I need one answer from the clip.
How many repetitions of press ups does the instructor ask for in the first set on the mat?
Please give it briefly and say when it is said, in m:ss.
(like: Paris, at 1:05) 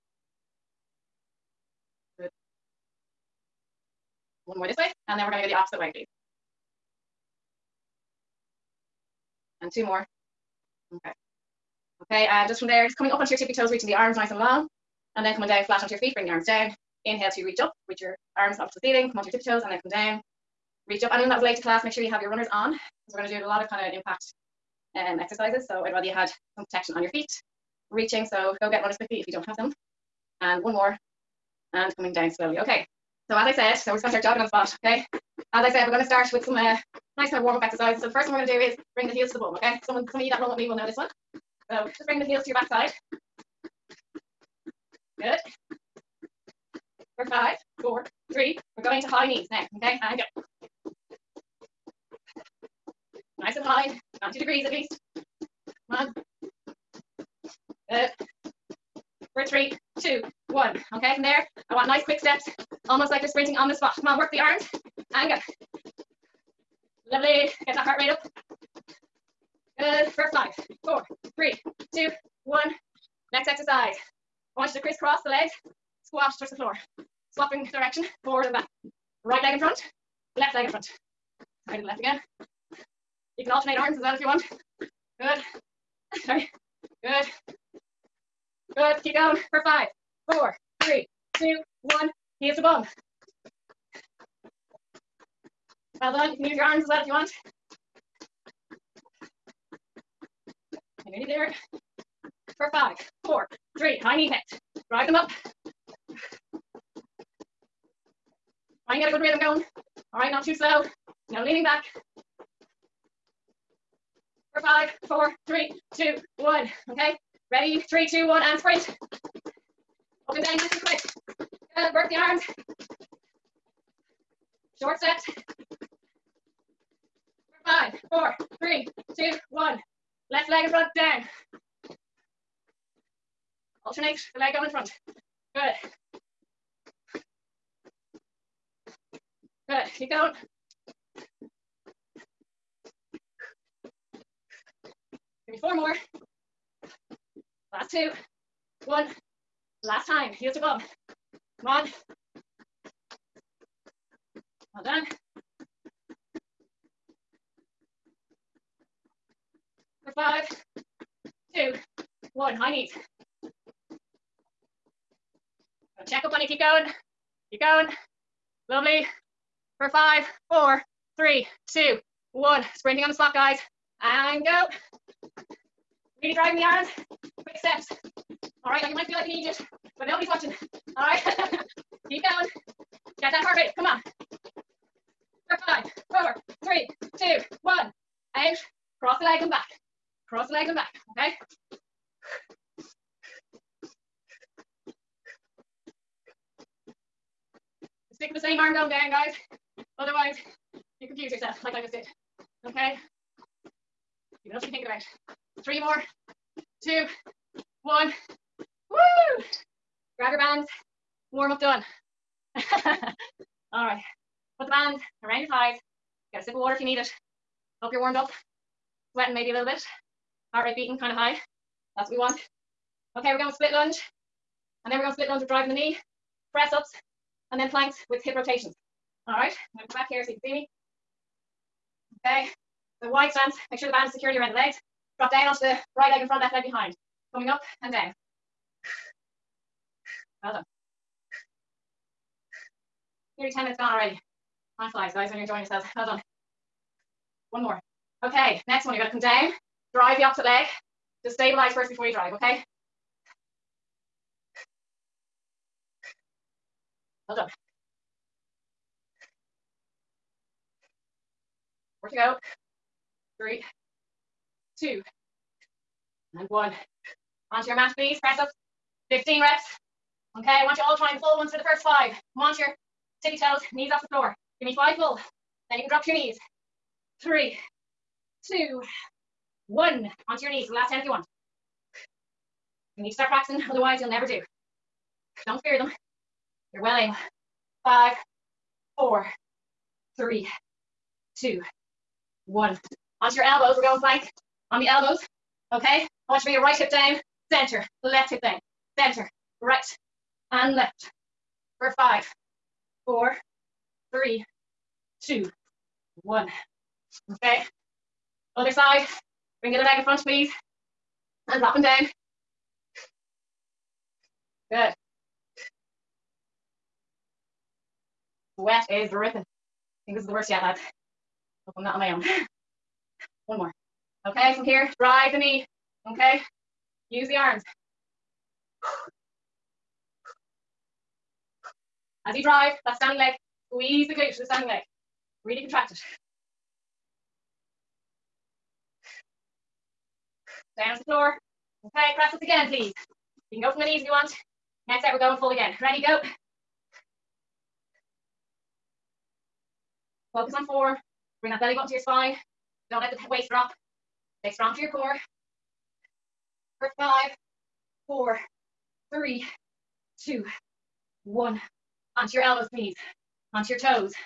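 15, at 4:29.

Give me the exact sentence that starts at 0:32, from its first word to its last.
Okay, so as I said, so we're just gonna start jogging on the spot, okay?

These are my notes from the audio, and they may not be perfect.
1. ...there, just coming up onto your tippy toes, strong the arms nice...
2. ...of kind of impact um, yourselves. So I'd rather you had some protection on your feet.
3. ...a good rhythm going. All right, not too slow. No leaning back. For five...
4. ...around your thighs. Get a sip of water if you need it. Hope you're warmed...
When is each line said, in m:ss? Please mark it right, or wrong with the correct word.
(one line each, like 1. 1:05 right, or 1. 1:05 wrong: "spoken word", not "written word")
1. 0:12 wrong: "reaching", not "strong"
2. 0:23 wrong: "exercises", not "yourselves"
3. 1:49 right
4. 3:35 right.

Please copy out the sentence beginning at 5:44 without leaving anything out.
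Next set, we're going full again.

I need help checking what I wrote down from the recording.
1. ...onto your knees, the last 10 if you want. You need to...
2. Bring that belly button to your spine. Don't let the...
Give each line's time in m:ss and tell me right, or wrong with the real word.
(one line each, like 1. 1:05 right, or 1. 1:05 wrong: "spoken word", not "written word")
1. 4:40 right
2. 5:51 right.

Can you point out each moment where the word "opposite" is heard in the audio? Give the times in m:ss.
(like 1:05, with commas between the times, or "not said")
0:05, 4:10.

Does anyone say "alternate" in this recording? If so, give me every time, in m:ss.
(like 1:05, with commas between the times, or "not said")
1:23, 2:13.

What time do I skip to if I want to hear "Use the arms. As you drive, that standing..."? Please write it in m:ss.
5:27.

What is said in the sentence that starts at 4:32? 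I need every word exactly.
Come your tippy toes, knees off the floor.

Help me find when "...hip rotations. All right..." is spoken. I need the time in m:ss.
3:48.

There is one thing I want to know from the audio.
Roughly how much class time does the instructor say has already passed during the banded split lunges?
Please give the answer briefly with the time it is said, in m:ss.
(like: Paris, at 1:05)
nearly 10 minutes, at 4:03.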